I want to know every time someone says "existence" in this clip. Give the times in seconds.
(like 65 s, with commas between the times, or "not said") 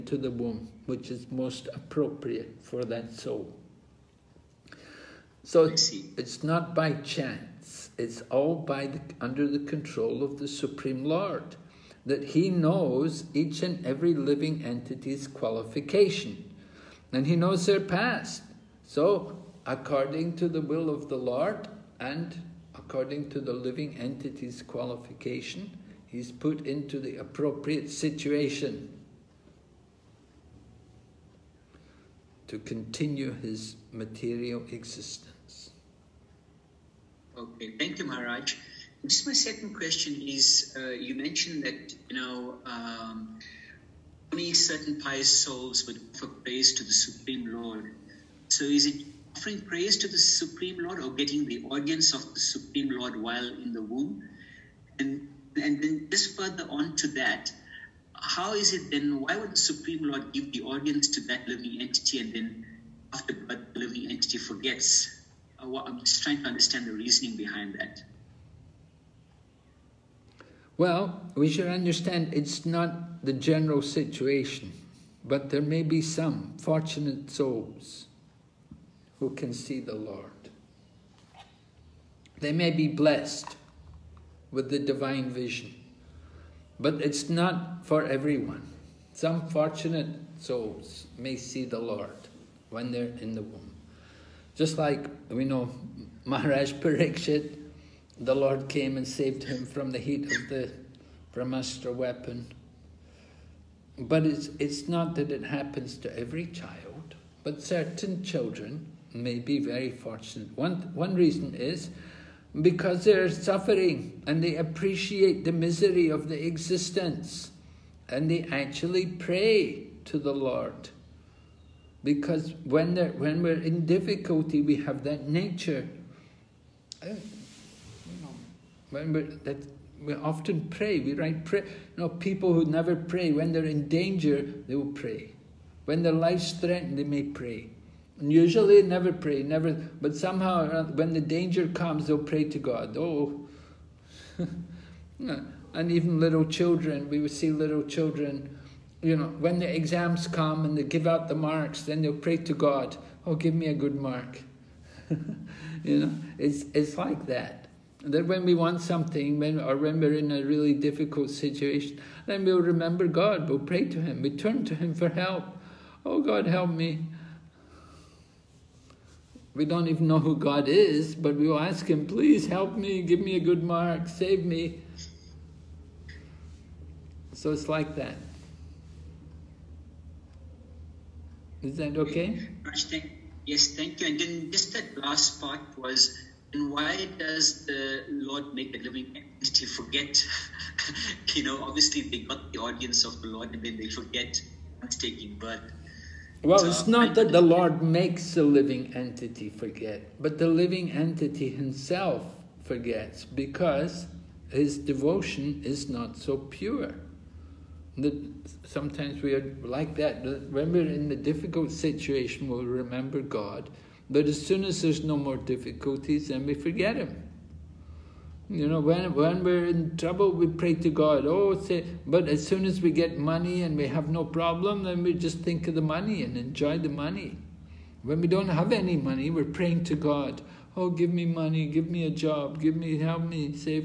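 34 s, 116 s.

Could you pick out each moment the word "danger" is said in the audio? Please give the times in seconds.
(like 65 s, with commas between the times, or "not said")
133 s, 141 s.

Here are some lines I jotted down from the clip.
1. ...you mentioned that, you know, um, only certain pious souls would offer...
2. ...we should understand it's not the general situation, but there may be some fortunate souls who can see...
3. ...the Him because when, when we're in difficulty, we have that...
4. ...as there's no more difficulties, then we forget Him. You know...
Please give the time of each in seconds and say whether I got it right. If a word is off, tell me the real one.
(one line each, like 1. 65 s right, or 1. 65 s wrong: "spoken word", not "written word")
1. 40 s right
2. 71 s right
3. 120 s wrong: "Lord", not "Him"
4. 214 s right.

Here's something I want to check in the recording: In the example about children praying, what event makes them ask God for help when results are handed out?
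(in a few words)
exams.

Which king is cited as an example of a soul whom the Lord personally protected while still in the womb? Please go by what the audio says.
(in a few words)
Pariksit.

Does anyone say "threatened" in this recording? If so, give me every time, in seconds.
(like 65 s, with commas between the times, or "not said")
136 s.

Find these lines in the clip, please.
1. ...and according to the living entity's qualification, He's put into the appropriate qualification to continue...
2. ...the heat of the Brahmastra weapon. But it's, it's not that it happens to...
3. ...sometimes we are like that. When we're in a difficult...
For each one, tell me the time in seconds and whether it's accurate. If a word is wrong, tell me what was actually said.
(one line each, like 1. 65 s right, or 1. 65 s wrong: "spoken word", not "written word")
1. 22 s wrong: "situation", not "qualification"
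2. 99 s right
3. 208 s right.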